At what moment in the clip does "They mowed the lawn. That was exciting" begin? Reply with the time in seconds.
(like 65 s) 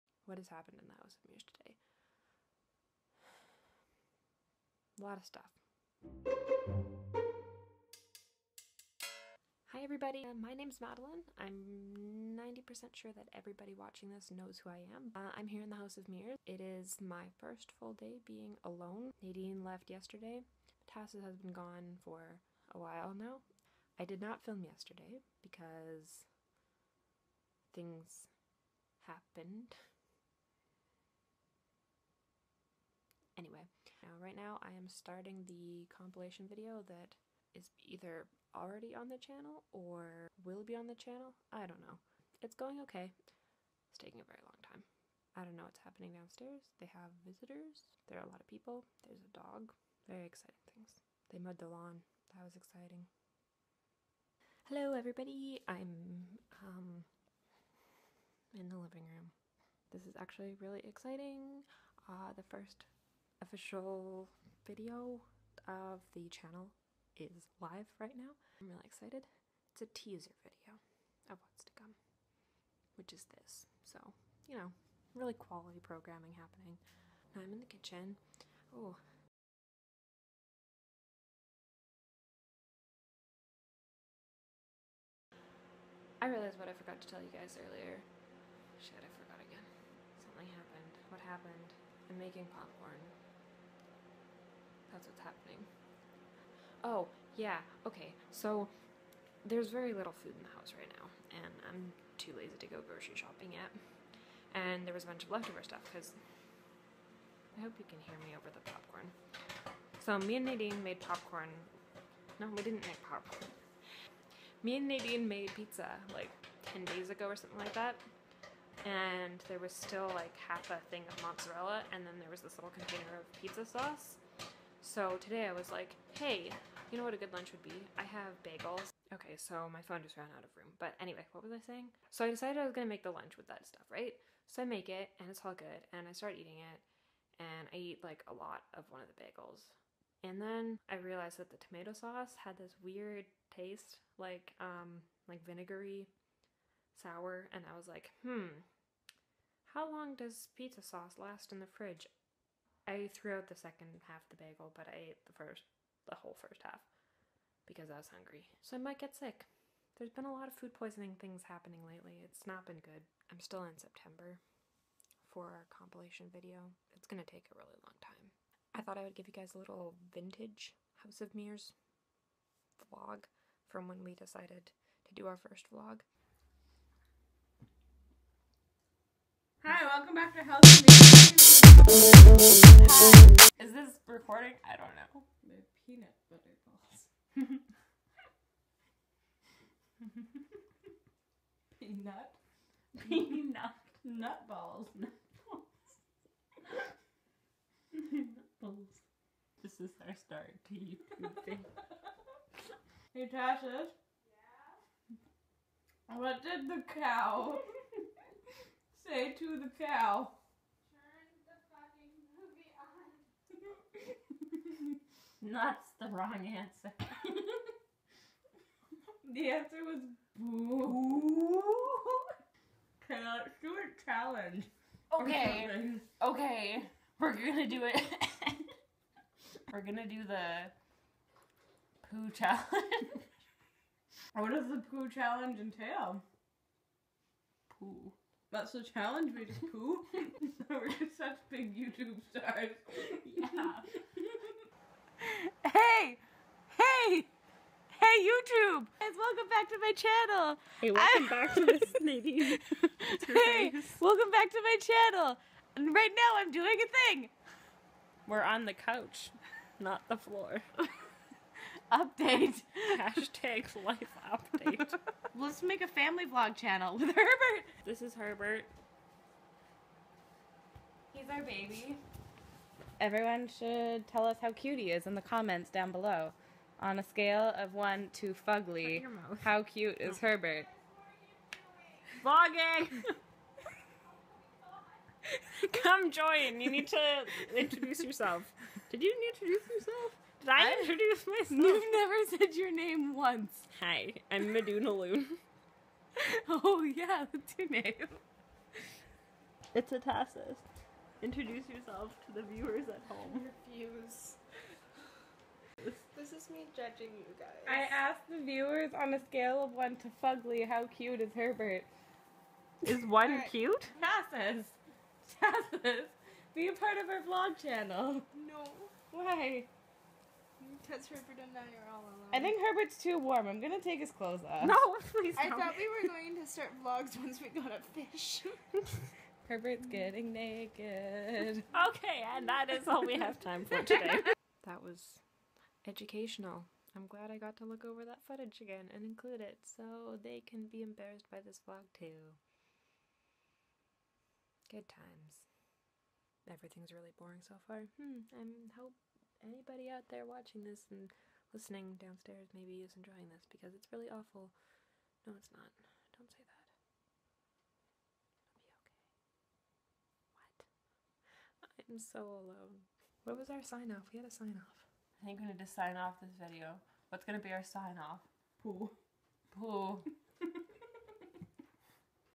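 51 s.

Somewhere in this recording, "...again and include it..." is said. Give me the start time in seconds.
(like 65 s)
338 s.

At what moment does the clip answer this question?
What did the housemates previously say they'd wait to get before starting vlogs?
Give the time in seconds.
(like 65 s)
327 s.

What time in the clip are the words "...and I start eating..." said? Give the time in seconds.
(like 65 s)
135 s.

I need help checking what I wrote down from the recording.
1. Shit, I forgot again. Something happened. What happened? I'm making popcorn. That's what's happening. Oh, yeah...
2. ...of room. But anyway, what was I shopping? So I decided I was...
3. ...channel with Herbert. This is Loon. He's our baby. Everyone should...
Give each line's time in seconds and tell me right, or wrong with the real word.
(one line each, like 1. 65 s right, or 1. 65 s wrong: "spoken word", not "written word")
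1. 88 s right
2. 130 s wrong: "saying", not "shopping"
3. 266 s wrong: "Herbert", not "Loon".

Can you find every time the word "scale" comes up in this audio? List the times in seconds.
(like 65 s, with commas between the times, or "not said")
277 s, 309 s.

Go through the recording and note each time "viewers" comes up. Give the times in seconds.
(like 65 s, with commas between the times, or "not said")
302 s, 308 s.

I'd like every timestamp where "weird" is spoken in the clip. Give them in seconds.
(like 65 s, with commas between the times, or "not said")
142 s.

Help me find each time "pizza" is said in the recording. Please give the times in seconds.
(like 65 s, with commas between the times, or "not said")
115 s, 123 s, 150 s.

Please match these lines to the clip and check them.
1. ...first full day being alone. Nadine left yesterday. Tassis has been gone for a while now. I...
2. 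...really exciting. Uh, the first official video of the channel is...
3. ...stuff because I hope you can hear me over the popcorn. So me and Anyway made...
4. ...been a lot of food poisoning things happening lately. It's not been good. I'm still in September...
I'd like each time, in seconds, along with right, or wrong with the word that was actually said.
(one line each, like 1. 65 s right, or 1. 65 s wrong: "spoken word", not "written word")
1. 17 s right
2. 60 s right
3. 105 s wrong: "Nadine", not "Anyway"
4. 160 s right.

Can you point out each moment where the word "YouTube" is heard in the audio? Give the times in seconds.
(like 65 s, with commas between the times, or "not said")
200 s, 241 s, 248 s.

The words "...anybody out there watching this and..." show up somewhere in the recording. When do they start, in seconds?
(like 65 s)
349 s.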